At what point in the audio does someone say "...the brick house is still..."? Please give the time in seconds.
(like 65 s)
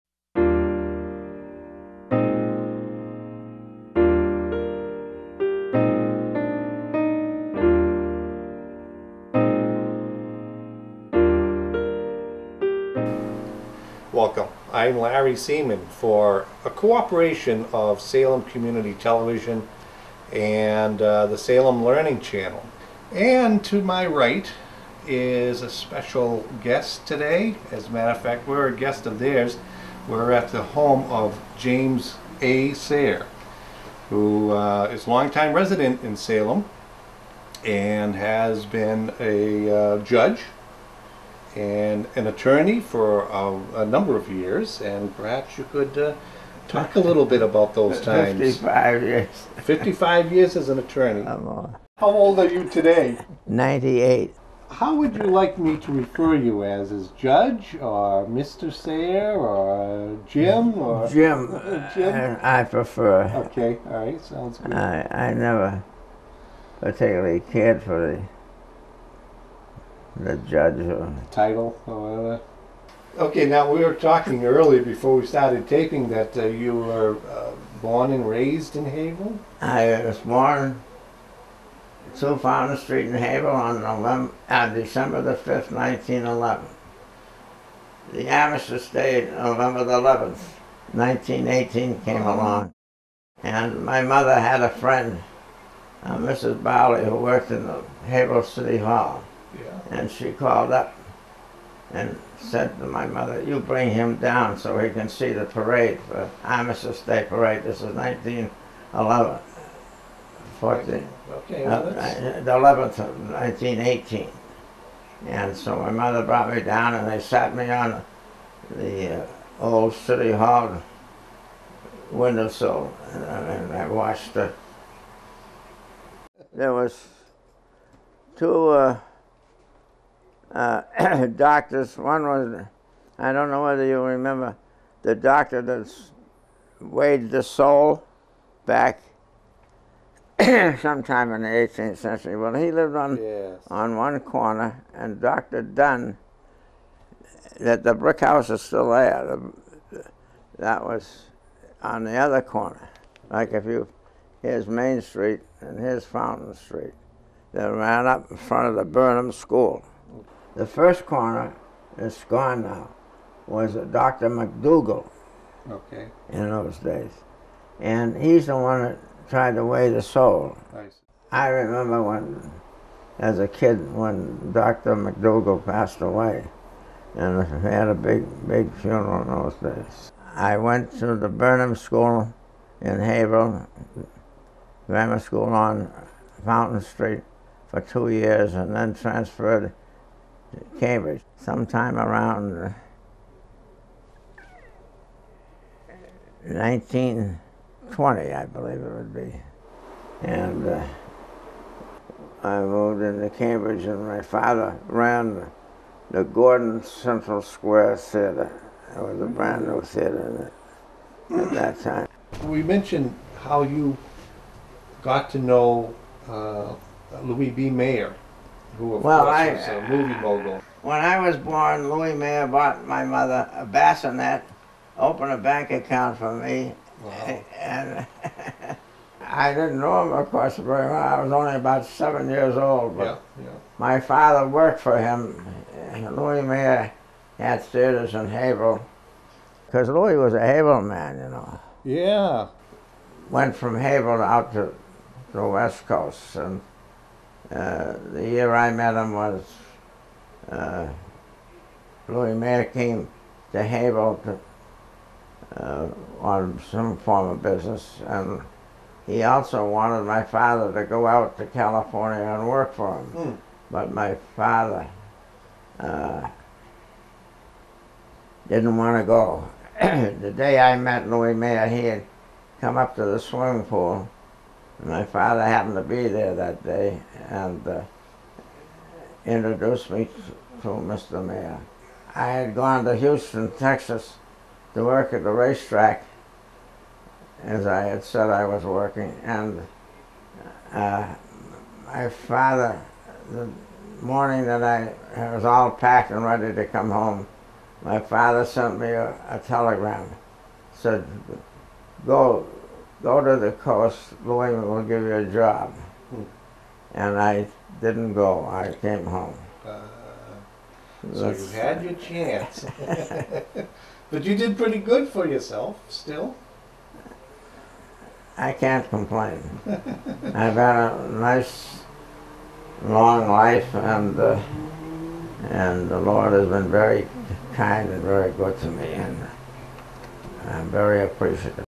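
147 s.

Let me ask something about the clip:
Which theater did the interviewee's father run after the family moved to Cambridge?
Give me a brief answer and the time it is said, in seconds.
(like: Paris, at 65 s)
Gordon Central Square Theater, at 206 s.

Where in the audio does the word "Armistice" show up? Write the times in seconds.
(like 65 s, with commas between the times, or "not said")
88 s, 106 s.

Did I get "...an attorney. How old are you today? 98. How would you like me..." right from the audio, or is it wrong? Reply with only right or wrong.
right.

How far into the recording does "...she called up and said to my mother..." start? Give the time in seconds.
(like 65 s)
100 s.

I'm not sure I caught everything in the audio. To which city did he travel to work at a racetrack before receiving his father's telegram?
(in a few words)
Houston, Texas.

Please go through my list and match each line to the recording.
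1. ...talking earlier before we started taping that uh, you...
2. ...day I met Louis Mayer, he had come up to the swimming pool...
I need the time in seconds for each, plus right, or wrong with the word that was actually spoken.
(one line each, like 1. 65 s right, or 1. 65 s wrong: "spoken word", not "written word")
1. 73 s right
2. 270 s right.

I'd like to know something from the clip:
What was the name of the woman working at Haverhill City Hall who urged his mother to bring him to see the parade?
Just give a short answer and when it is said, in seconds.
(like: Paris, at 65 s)
Mrs. Bowley, at 96 s.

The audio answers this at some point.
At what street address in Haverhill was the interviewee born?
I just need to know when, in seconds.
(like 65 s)
82 s.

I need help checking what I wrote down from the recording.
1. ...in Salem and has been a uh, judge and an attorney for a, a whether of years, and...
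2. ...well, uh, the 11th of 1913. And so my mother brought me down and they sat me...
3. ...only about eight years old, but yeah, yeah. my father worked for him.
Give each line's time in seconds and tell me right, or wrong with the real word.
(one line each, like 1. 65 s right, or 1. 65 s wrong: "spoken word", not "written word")
1. 36 s wrong: "number", not "whether"
2. 111 s wrong: "1918", not "1913"
3. 231 s wrong: "seven", not "eight".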